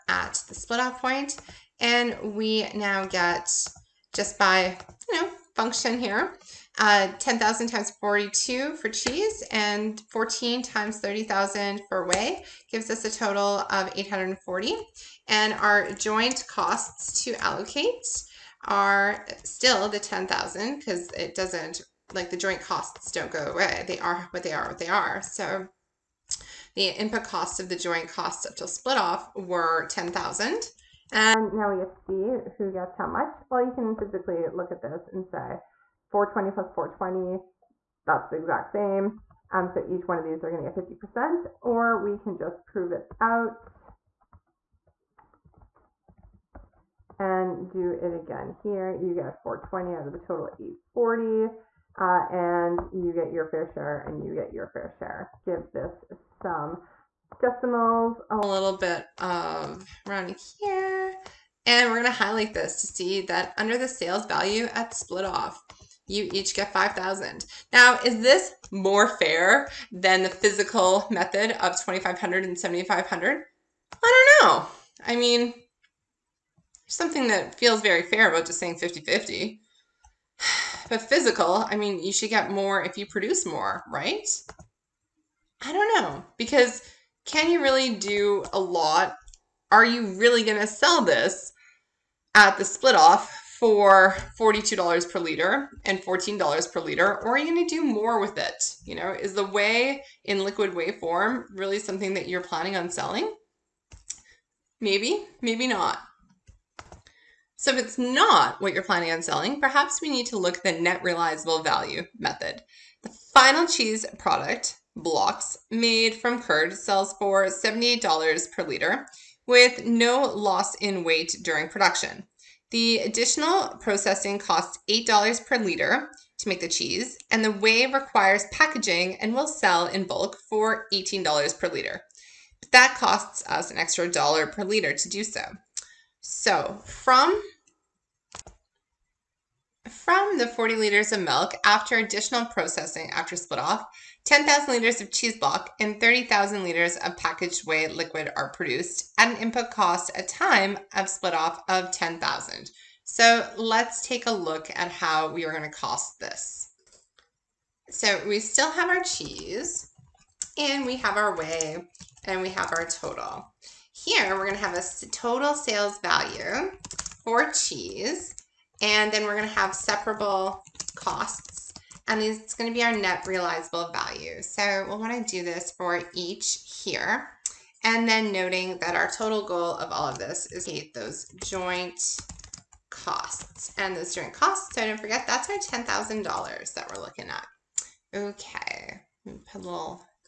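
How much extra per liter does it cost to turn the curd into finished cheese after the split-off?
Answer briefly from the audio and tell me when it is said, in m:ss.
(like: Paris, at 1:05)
$8, at 2:04.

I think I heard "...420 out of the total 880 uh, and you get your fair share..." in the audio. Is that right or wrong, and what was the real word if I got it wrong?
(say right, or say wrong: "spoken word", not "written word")
wrong: "840", not "880".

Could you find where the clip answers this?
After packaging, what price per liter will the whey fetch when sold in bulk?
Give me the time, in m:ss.
2:10.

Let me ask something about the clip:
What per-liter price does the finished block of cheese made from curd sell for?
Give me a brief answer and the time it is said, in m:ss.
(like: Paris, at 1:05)
$78, at 1:57.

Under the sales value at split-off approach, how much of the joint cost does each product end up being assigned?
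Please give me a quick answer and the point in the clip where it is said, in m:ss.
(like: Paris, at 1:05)
5,000, at 1:06.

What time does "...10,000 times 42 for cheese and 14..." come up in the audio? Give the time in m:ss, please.
0:07.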